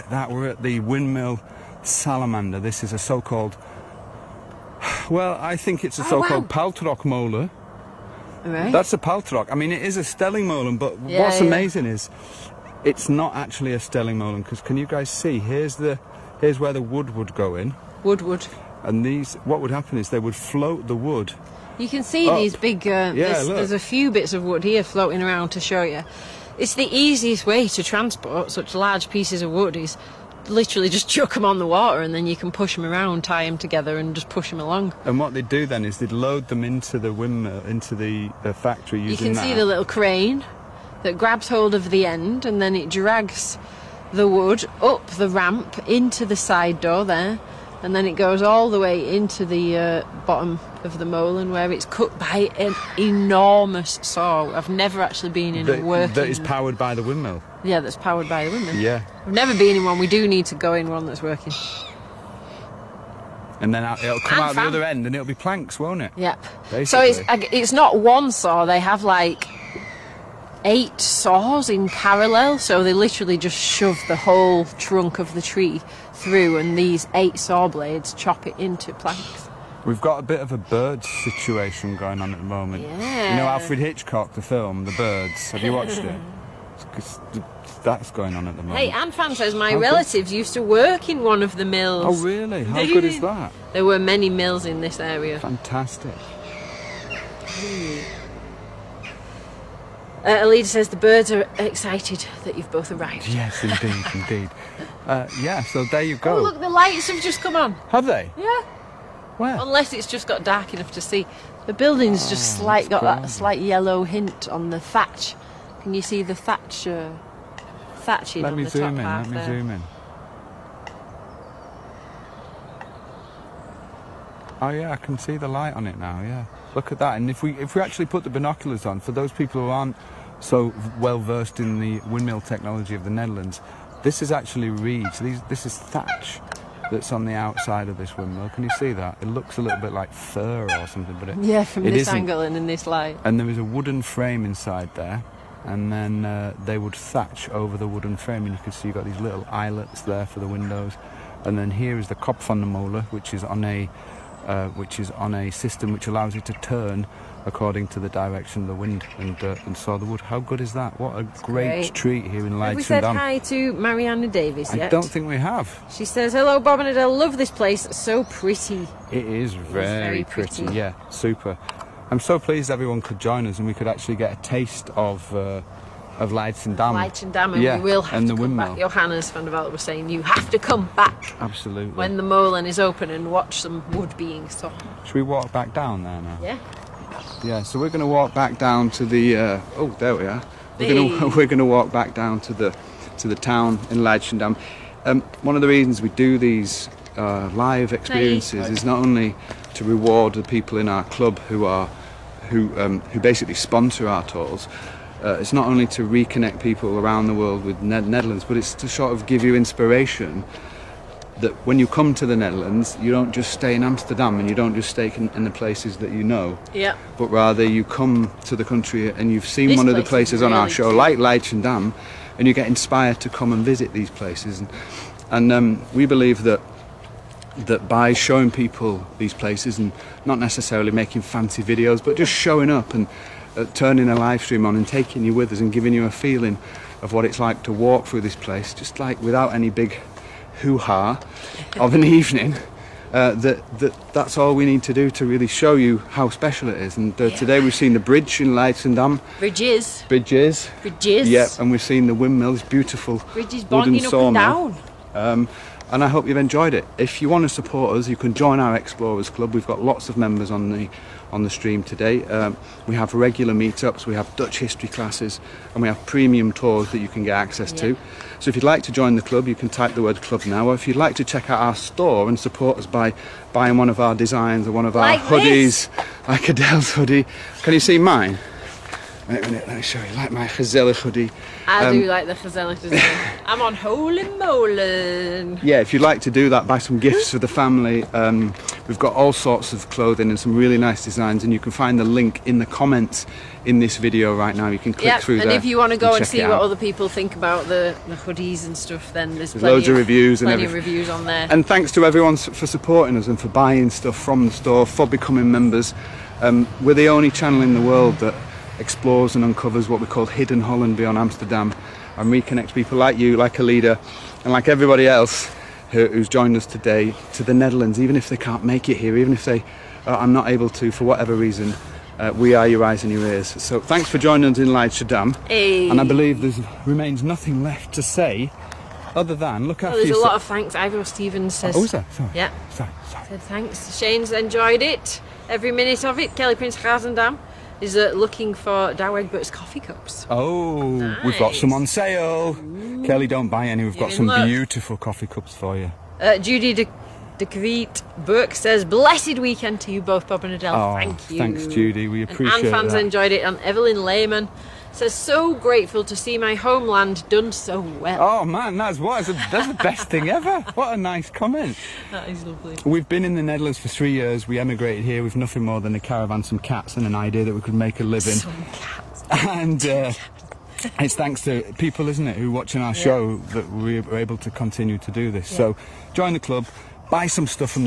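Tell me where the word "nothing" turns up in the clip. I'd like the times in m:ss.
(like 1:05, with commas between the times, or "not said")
5:27, 6:05.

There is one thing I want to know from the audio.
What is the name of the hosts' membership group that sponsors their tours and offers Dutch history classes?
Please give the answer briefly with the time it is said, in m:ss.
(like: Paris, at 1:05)
Explorers Club, at 4:18.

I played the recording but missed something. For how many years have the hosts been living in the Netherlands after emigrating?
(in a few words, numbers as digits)
3.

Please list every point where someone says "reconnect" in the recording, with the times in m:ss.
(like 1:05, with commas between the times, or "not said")
3:26, 5:12.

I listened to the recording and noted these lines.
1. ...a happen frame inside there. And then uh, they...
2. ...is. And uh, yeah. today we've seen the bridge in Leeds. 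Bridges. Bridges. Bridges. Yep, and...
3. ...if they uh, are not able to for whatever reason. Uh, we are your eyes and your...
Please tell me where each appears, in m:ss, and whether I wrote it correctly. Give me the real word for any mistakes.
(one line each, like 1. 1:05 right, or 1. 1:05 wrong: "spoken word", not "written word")
1. 2:23 wrong: "wooden", not "happen"
2. 4:06 wrong: "Leidschendam", not "Leeds"
3. 5:19 right.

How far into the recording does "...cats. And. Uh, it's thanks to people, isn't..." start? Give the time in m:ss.
6:08.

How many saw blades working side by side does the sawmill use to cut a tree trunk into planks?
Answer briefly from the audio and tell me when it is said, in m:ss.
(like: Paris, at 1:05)
8, at 1:10.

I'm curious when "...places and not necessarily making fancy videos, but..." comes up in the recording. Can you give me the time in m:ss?
3:49.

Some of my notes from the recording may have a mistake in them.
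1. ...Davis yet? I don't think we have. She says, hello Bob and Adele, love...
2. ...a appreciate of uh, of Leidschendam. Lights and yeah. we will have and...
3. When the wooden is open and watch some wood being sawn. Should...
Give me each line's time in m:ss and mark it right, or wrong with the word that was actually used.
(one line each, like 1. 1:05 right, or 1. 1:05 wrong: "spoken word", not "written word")
1. 2:44 right
2. 2:54 wrong: "taste", not "appreciate"
3. 3:01 wrong: "molen", not "wooden".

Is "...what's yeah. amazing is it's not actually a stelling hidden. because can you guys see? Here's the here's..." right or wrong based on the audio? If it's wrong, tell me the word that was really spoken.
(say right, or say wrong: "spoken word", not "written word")
wrong: "molen", not "hidden".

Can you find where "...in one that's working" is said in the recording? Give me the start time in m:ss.
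1:00.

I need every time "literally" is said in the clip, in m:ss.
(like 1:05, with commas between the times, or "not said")
0:30, 1:12.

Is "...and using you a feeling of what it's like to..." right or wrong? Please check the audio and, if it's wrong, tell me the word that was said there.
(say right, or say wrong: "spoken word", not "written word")
wrong: "giving", not "using".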